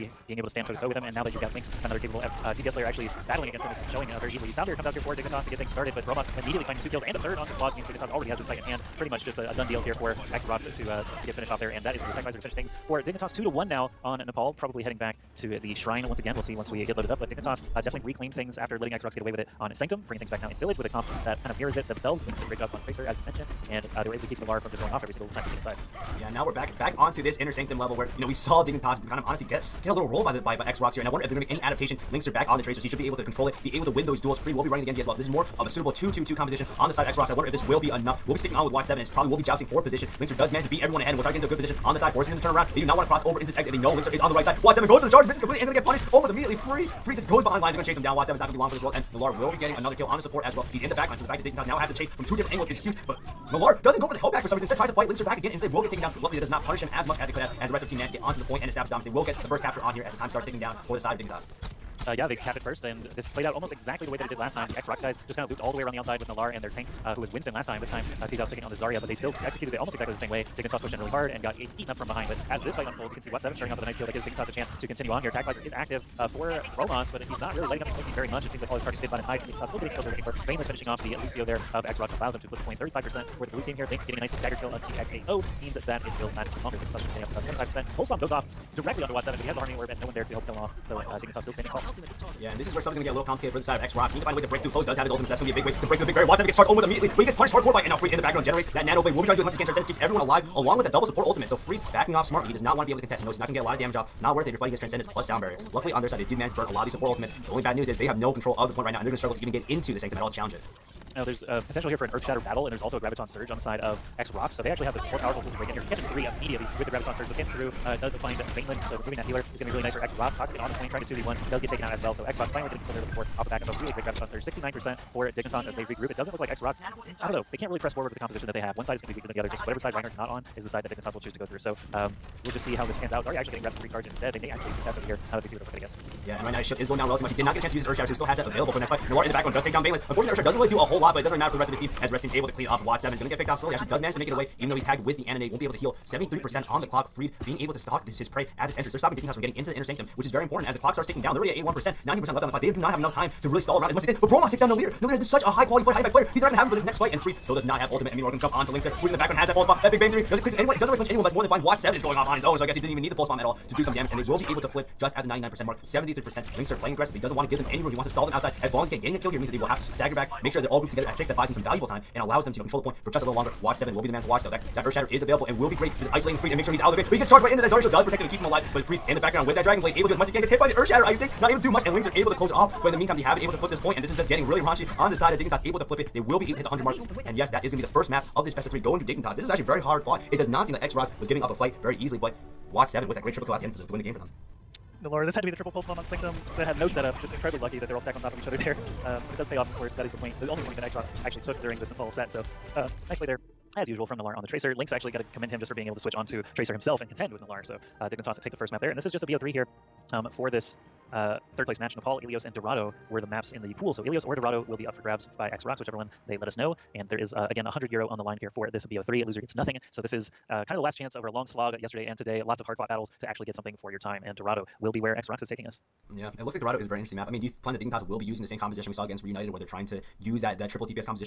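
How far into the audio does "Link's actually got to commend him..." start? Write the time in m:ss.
3:24.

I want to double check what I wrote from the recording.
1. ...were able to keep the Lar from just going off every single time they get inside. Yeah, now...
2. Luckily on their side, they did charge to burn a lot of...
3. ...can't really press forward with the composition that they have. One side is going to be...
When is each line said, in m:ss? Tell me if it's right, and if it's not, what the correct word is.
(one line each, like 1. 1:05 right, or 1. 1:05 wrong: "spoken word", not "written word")
1. 0:24 right
2. 1:45 wrong: "manage", not "charge"
3. 2:07 right.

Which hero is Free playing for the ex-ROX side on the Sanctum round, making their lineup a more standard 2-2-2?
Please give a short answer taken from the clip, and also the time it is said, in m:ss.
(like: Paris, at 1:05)
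Genji, at 0:34.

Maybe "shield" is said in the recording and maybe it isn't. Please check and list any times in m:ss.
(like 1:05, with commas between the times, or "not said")
2:16, 2:57.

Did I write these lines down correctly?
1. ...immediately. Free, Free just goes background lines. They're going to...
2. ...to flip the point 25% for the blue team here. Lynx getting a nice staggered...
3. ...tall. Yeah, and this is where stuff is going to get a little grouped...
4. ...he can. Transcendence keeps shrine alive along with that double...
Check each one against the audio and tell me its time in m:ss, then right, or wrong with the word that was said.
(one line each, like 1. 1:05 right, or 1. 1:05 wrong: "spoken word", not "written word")
1. 0:46 wrong: "behind", not "background"
2. 1:22 wrong: "35", not "25"
3. 1:31 wrong: "complicated", not "grouped"
4. 1:39 wrong: "everyone", not "shrine".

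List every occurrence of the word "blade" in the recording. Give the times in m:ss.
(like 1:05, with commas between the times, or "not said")
1:39, 2:59.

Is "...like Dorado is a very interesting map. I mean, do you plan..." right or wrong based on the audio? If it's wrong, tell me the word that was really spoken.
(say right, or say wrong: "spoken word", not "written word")
right.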